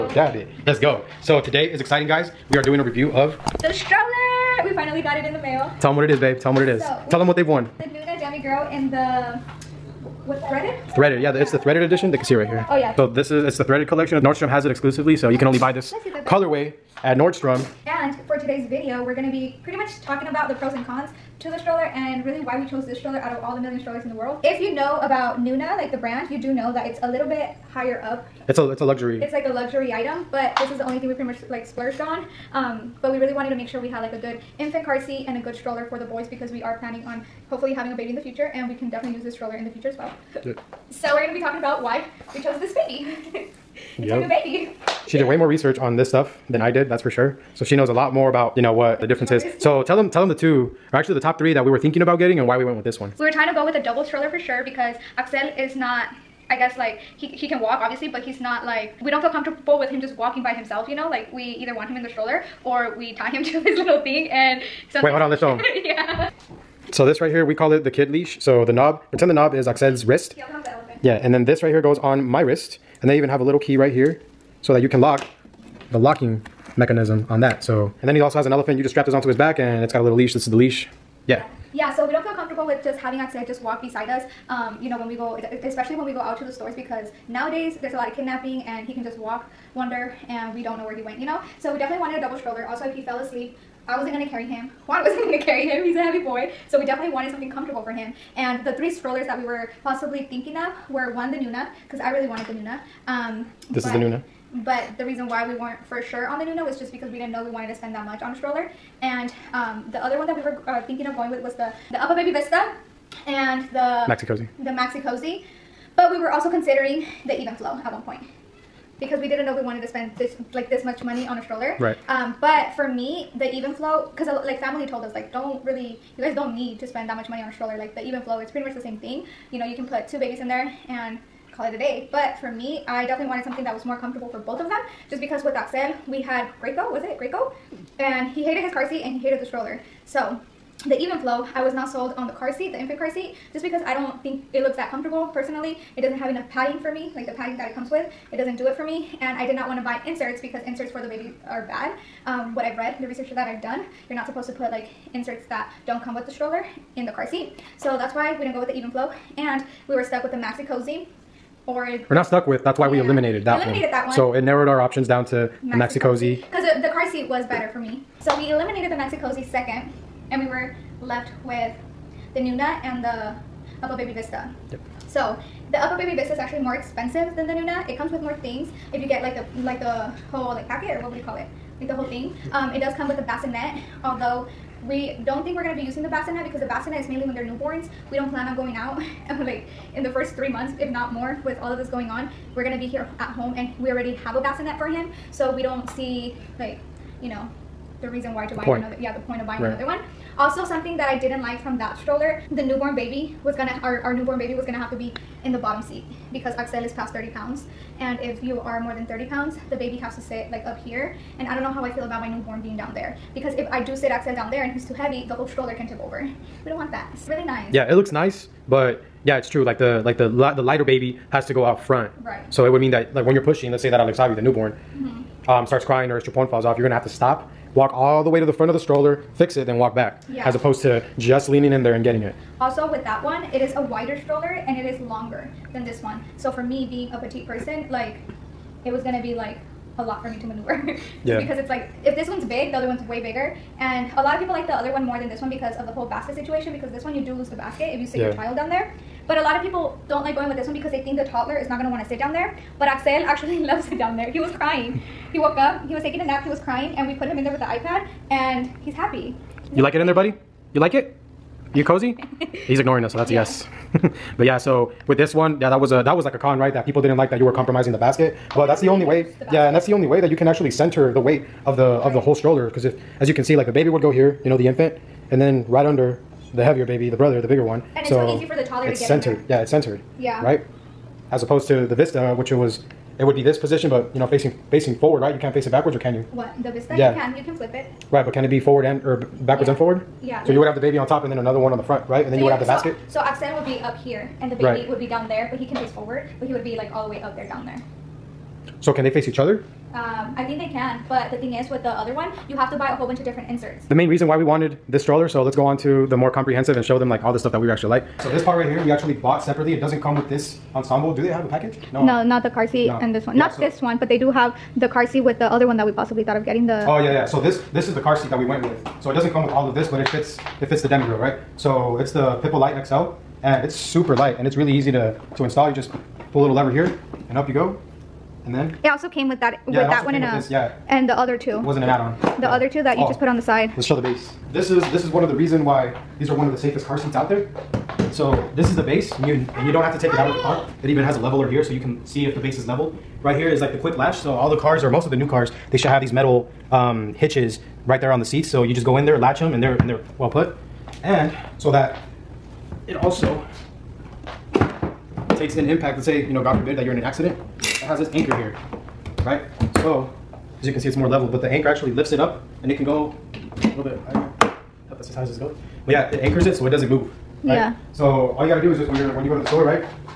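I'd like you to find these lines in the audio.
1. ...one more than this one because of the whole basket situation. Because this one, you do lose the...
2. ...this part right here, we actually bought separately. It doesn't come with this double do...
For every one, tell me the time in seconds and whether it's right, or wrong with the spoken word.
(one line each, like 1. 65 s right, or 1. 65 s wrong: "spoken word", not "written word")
1. 244 s right
2. 308 s wrong: "ensemble", not "double".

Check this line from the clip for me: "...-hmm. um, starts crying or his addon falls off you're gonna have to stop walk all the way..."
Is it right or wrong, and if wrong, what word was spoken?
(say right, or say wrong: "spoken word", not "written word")
wrong: "chupon", not "addon".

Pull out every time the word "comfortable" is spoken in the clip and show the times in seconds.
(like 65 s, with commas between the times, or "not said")
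59 s, 82 s, 97 s, 133 s, 144 s.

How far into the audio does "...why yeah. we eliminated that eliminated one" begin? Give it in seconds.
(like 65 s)
162 s.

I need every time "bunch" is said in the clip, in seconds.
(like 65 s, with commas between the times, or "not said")
303 s.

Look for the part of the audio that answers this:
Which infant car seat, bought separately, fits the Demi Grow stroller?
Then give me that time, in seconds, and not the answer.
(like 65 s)
322 s.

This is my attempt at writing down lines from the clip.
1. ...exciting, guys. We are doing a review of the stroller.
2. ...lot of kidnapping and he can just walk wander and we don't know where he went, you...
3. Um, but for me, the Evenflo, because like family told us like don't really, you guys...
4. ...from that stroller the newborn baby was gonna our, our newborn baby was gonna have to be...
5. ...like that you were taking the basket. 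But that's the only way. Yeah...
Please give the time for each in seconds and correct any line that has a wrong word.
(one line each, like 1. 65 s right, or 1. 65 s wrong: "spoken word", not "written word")
1. 1 s right
2. 87 s right
3. 122 s right
4. 201 s right
5. 267 s wrong: "compromising", not "taking".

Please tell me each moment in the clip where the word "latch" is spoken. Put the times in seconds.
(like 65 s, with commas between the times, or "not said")
343 s, 349 s.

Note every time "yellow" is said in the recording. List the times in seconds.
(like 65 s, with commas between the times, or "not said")
not said.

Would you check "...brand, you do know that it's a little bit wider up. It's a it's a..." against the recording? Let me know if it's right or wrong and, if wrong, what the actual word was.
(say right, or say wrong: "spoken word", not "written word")
wrong: "higher", not "wider".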